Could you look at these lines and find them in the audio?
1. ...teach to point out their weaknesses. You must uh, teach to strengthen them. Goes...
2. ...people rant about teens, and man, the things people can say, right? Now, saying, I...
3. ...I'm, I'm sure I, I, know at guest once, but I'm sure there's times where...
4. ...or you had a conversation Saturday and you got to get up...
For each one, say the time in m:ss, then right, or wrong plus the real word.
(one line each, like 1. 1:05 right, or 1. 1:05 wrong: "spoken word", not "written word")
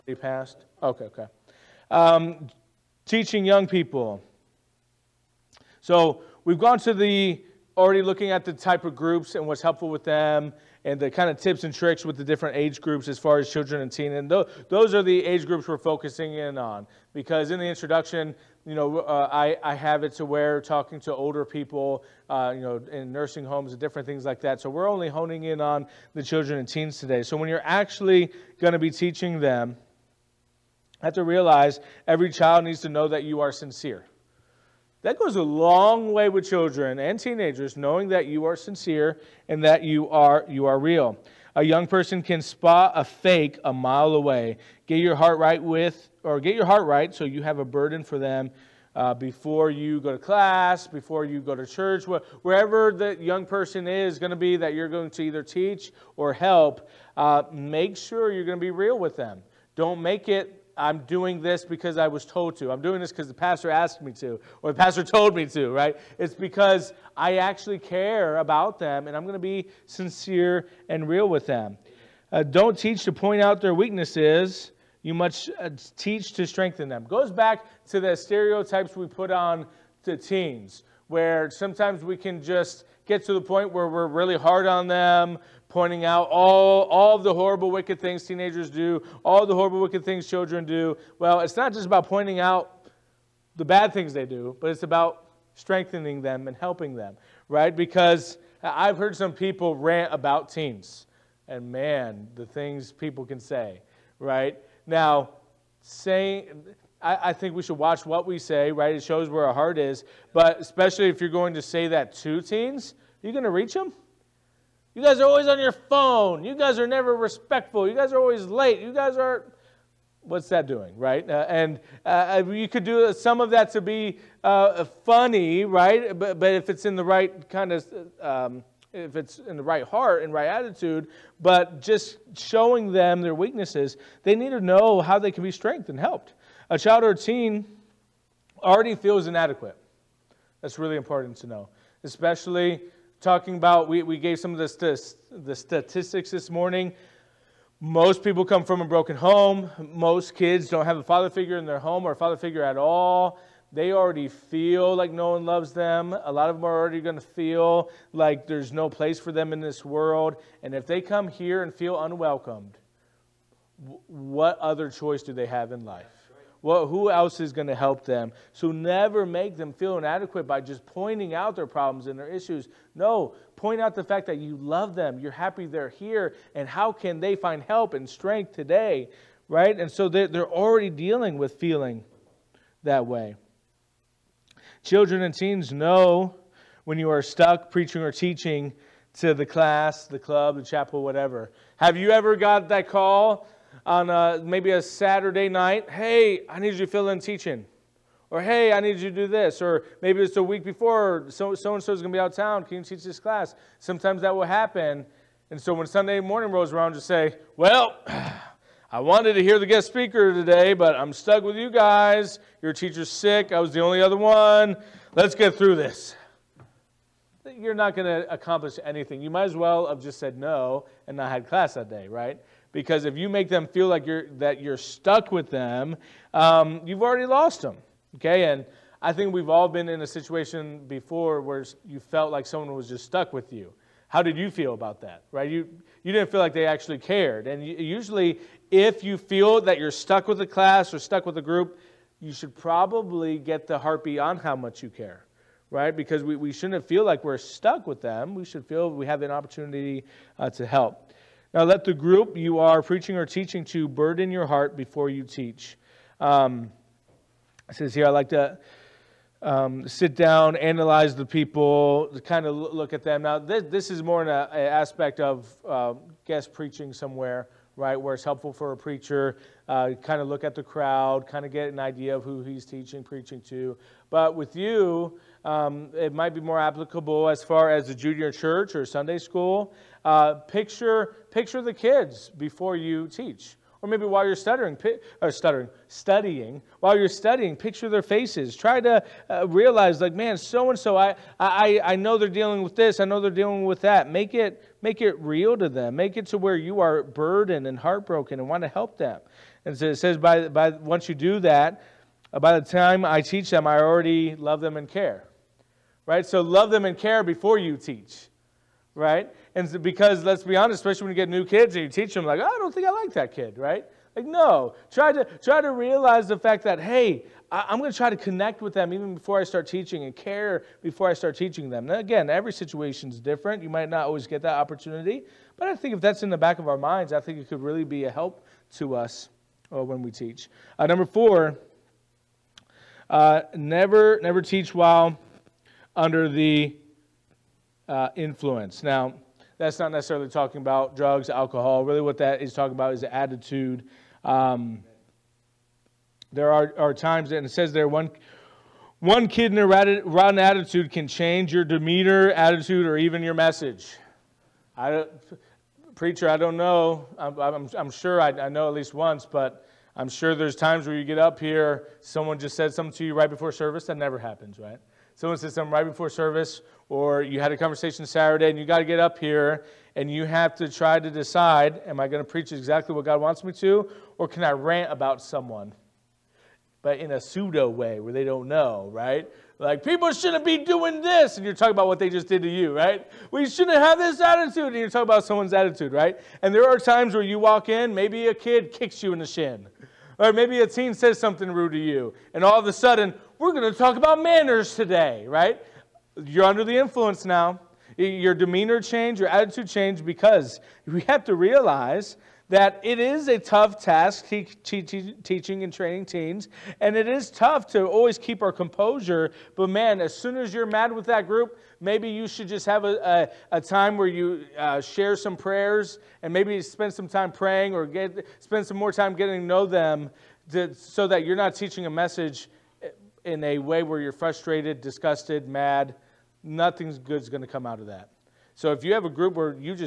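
1. 1:12 right
2. 1:39 right
3. 5:57 wrong: "least", not "guest"
4. 6:06 right.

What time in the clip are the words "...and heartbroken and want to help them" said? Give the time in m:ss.
4:57.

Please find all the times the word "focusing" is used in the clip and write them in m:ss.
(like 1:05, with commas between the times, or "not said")
0:15.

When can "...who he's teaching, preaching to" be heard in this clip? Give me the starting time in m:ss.
4:32.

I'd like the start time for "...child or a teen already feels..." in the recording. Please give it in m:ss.
2:16.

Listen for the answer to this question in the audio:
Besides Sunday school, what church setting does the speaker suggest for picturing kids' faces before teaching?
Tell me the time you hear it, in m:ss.
4:37.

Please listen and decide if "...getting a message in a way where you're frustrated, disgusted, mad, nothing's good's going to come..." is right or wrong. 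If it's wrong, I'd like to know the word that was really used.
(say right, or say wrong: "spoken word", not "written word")
wrong: "teaching", not "getting".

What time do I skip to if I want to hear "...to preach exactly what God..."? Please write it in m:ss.
6:12.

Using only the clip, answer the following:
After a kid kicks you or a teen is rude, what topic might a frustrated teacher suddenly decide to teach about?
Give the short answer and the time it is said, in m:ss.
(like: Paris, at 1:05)
Manners, at 6:34.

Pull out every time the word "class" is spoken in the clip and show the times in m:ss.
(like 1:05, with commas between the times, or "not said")
0:50, 3:09, 3:23, 3:41, 4:00.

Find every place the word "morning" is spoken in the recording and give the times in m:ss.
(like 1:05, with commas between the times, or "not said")
2:26, 3:26.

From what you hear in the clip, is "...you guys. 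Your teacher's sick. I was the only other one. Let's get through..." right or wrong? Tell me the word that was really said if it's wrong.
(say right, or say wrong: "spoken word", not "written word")
right.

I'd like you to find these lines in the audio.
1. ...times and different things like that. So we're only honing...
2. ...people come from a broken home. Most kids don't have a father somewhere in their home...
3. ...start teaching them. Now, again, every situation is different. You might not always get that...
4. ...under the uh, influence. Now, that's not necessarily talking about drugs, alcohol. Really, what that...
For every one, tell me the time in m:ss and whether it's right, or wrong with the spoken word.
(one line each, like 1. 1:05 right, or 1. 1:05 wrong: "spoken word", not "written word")
1. 0:23 wrong: "homes", not "times"
2. 2:28 wrong: "figure", not "somewhere"
3. 5:21 right
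4. 5:35 right.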